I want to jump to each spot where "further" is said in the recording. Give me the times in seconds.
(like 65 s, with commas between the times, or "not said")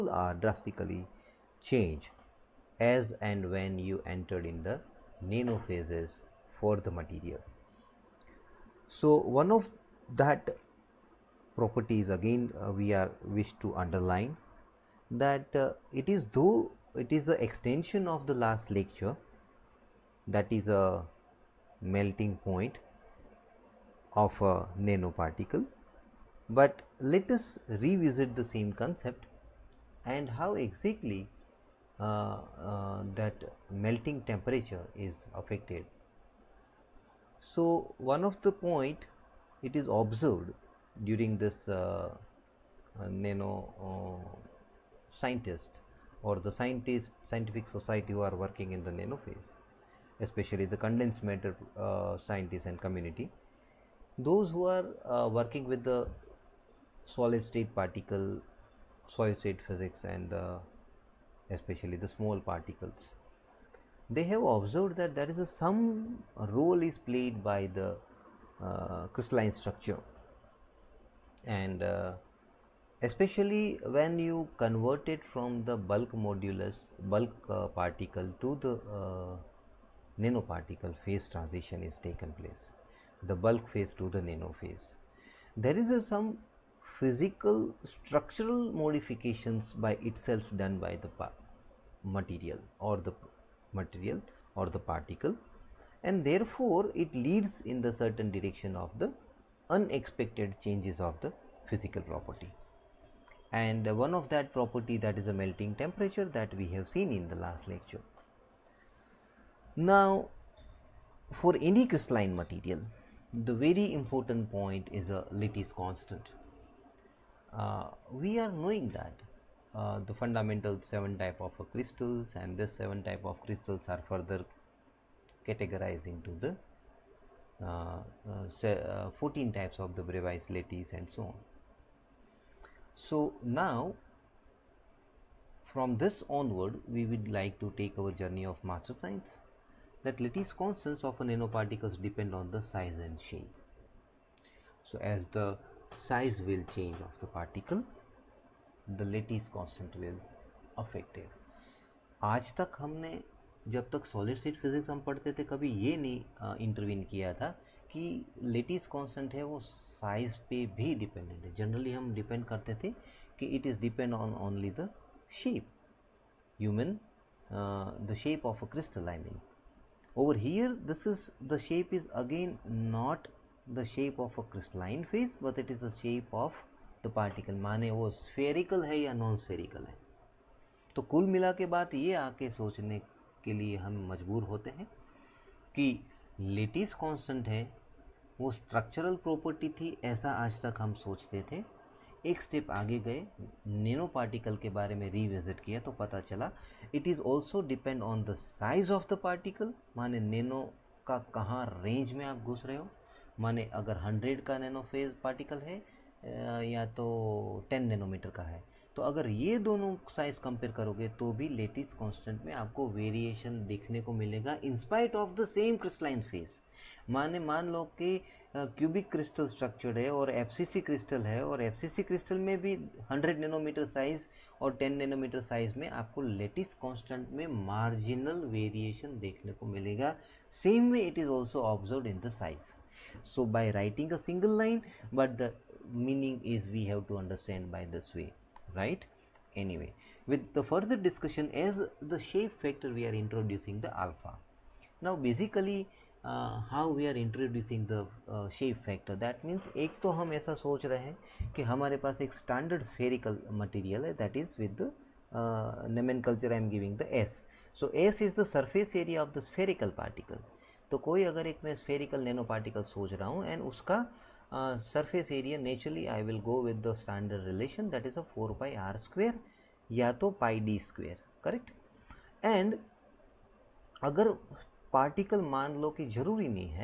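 124 s, 240 s.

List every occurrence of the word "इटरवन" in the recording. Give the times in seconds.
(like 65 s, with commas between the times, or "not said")
156 s.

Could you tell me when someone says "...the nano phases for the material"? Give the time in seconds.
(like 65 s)
4 s.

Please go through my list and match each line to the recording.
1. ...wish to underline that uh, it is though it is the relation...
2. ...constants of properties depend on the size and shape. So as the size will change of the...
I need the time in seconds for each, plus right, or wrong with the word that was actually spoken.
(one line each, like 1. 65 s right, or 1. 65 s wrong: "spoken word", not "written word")
1. 13 s wrong: "extension", not "relation"
2. 140 s wrong: "nanoparticles", not "properties".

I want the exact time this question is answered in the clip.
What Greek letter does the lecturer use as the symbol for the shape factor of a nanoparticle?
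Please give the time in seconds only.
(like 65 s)
244 s.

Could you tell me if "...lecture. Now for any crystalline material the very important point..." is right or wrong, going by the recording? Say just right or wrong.
right.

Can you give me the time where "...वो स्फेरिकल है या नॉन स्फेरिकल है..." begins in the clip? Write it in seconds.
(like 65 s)
177 s.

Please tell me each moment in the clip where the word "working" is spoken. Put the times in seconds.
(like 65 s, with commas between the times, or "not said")
48 s, 55 s.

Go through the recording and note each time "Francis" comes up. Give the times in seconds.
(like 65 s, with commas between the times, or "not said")
not said.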